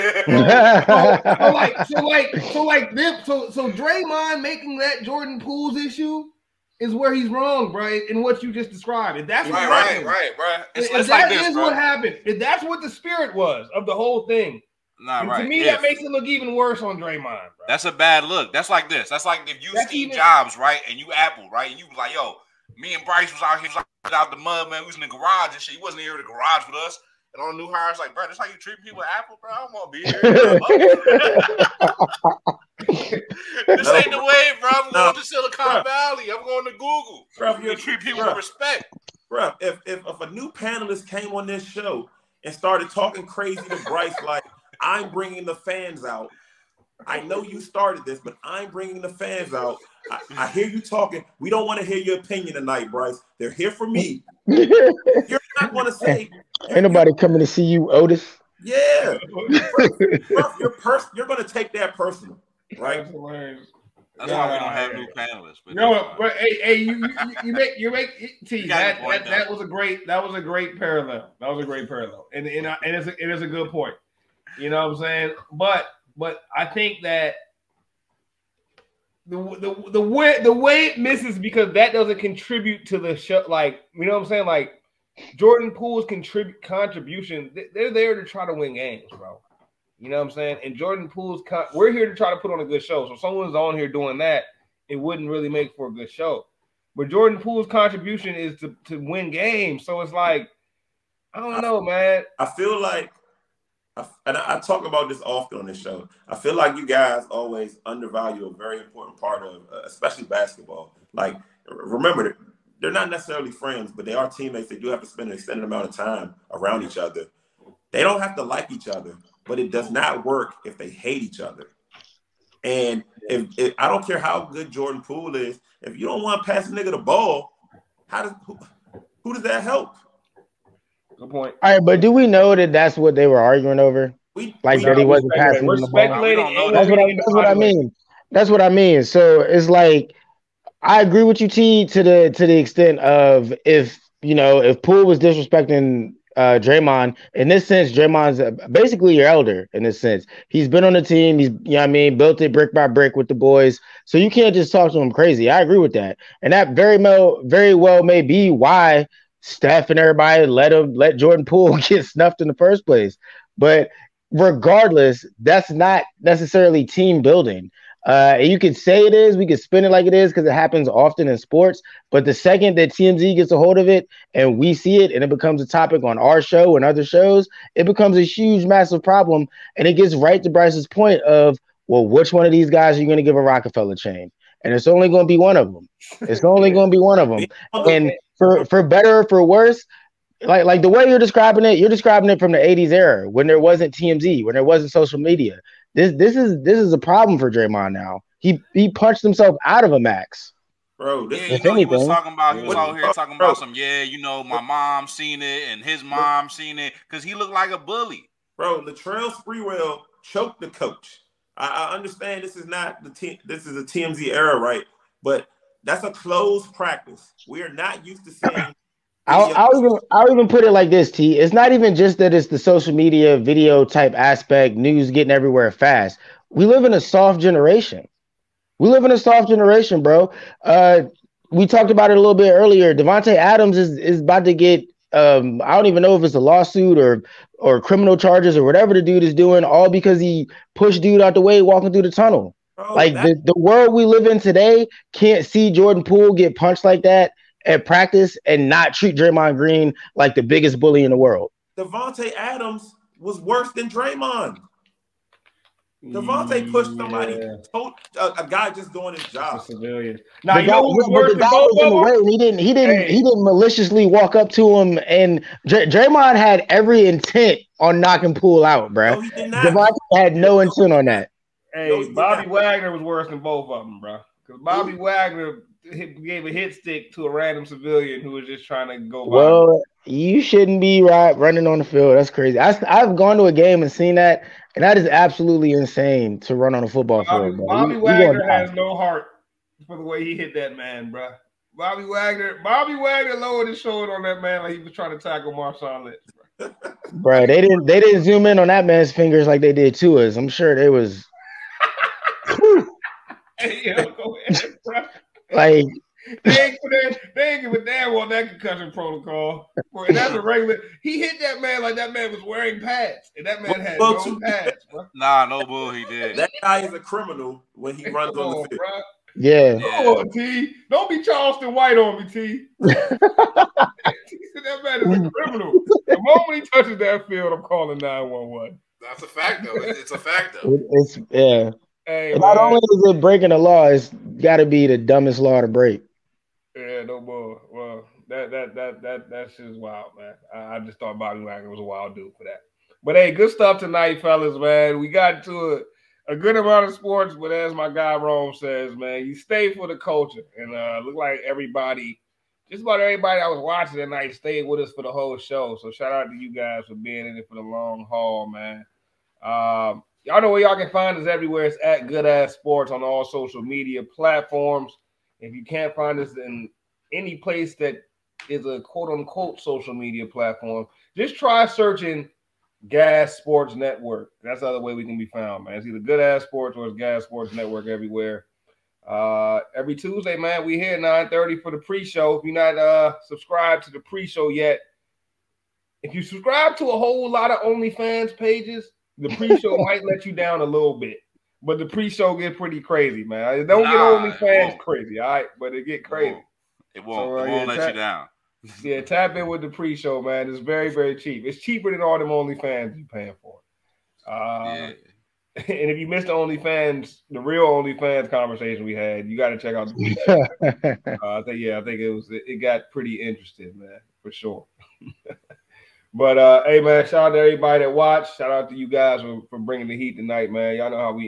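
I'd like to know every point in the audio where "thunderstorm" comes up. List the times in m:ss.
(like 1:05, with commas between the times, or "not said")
not said.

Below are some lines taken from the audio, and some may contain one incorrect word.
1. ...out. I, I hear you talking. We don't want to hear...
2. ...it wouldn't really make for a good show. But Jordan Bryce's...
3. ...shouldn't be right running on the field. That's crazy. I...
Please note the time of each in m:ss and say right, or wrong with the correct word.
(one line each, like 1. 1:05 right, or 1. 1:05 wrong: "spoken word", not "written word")
1. 0:49 right
2. 1:34 wrong: "Poole", not "Bryce"
3. 4:40 right.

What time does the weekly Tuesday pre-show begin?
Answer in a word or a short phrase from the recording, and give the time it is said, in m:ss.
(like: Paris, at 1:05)
9:30, at 6:20.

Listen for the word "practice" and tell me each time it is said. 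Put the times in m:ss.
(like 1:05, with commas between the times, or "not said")
3:36, 4:07.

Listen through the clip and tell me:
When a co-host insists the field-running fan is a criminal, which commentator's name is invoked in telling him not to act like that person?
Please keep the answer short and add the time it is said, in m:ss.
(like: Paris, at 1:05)
Charleston White, at 5:21.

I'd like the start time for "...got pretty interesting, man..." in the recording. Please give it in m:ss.
6:52.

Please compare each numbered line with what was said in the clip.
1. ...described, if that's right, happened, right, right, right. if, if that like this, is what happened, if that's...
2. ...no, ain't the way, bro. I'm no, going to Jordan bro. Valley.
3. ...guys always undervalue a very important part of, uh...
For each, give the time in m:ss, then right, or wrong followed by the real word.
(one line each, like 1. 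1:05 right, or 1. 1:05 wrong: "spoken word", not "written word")
1. 0:08 right
2. 0:33 wrong: "Silicon", not "Jordan"
3. 1:46 right.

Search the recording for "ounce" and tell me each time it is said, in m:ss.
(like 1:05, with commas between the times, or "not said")
not said.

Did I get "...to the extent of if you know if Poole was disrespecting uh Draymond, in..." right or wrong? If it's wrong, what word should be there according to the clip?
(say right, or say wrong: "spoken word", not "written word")
right.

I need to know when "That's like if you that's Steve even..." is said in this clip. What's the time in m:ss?
0:19.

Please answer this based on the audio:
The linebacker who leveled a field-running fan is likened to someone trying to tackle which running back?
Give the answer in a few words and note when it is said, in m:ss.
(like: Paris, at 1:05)
Marshawn Lynch, at 4:55.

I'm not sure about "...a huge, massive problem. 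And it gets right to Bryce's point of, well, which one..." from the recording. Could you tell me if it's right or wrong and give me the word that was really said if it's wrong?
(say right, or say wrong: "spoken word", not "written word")
right.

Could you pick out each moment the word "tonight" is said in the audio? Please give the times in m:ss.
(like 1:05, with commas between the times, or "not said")
0:52, 5:43, 5:53, 7:00.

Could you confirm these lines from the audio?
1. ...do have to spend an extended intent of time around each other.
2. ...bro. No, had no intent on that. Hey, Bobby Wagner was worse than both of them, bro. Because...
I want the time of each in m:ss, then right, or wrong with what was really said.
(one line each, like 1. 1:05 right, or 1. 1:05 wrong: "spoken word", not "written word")
1. 1:54 wrong: "amount", not "intent"
2. 4:28 right.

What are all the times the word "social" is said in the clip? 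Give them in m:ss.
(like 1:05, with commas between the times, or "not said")
3:14, 3:42, 6:03, 6:09.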